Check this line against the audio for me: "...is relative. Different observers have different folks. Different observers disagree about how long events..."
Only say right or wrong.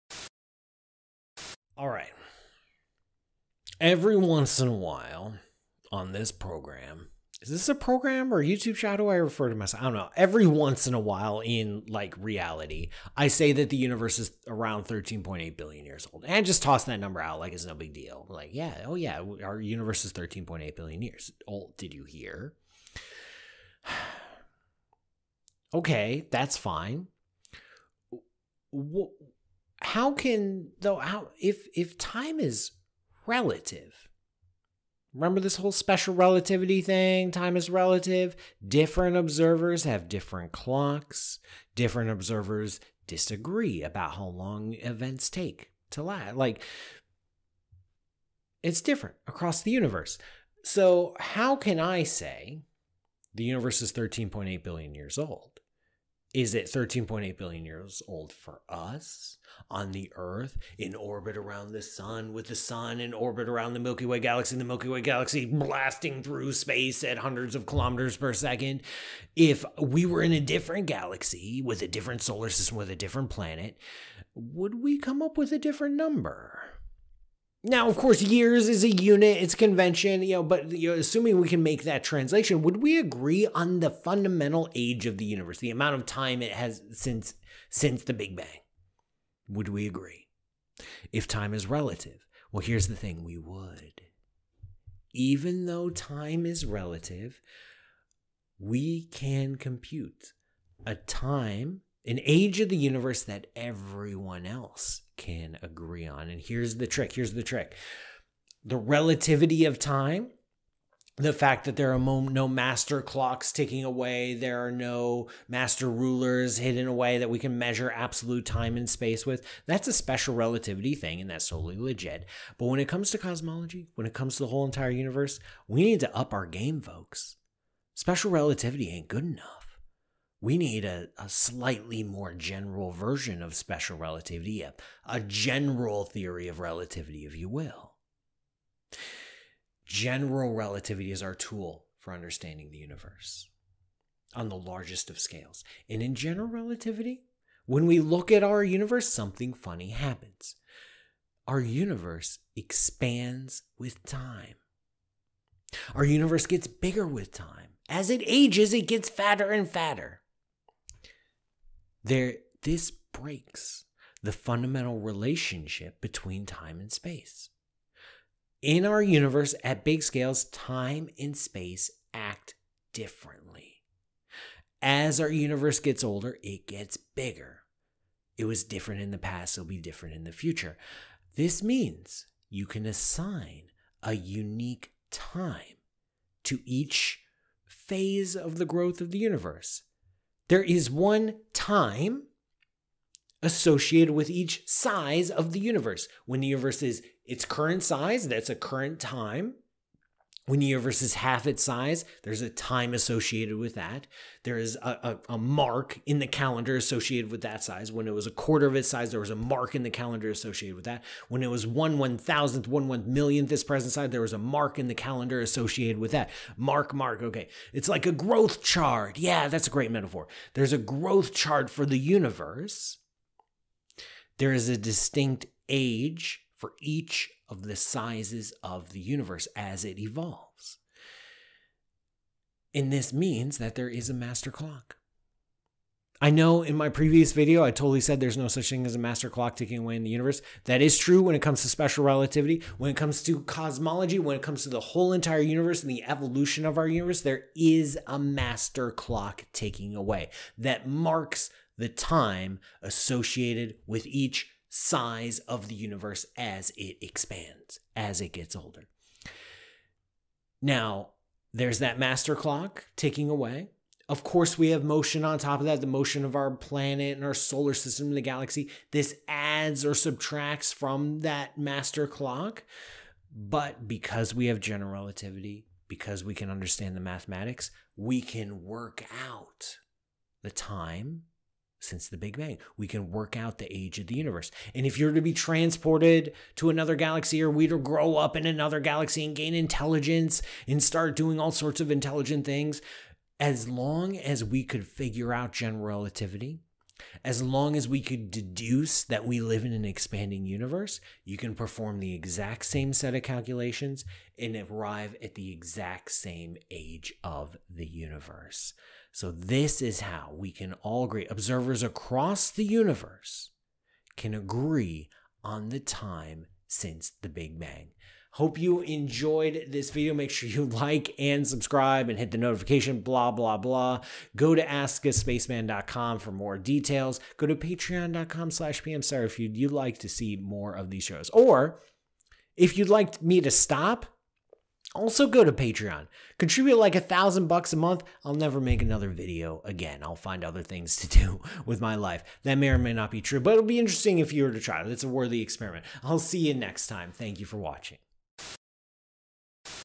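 wrong.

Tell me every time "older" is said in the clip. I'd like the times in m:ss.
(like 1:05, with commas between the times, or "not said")
2:56, 4:18.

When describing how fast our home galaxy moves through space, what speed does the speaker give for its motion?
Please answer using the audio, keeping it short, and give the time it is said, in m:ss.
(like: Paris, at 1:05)
hundreds of kilometers per second, at 1:07.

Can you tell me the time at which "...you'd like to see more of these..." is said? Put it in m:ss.
5:29.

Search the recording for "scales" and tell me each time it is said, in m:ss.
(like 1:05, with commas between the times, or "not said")
2:25, 2:50.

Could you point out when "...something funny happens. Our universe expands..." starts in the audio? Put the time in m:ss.
2:29.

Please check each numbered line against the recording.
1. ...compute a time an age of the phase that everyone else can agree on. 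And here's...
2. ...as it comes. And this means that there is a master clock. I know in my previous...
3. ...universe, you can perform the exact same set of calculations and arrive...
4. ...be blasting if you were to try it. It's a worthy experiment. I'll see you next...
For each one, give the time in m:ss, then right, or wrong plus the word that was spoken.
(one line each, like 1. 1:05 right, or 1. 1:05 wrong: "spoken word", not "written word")
1. 1:39 wrong: "universe", not "phase"
2. 3:49 wrong: "evolves", not "comes"
3. 5:00 right
4. 5:43 wrong: "interesting", not "blasting".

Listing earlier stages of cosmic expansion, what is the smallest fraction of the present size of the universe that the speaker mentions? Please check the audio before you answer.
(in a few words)
one millionth.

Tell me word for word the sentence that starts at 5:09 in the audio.
So, this is how we can all agree, observers across the universe can agree on the time since the Big Bang.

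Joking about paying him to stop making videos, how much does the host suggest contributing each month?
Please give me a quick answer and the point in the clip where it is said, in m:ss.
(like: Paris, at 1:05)
$1,000, at 5:36.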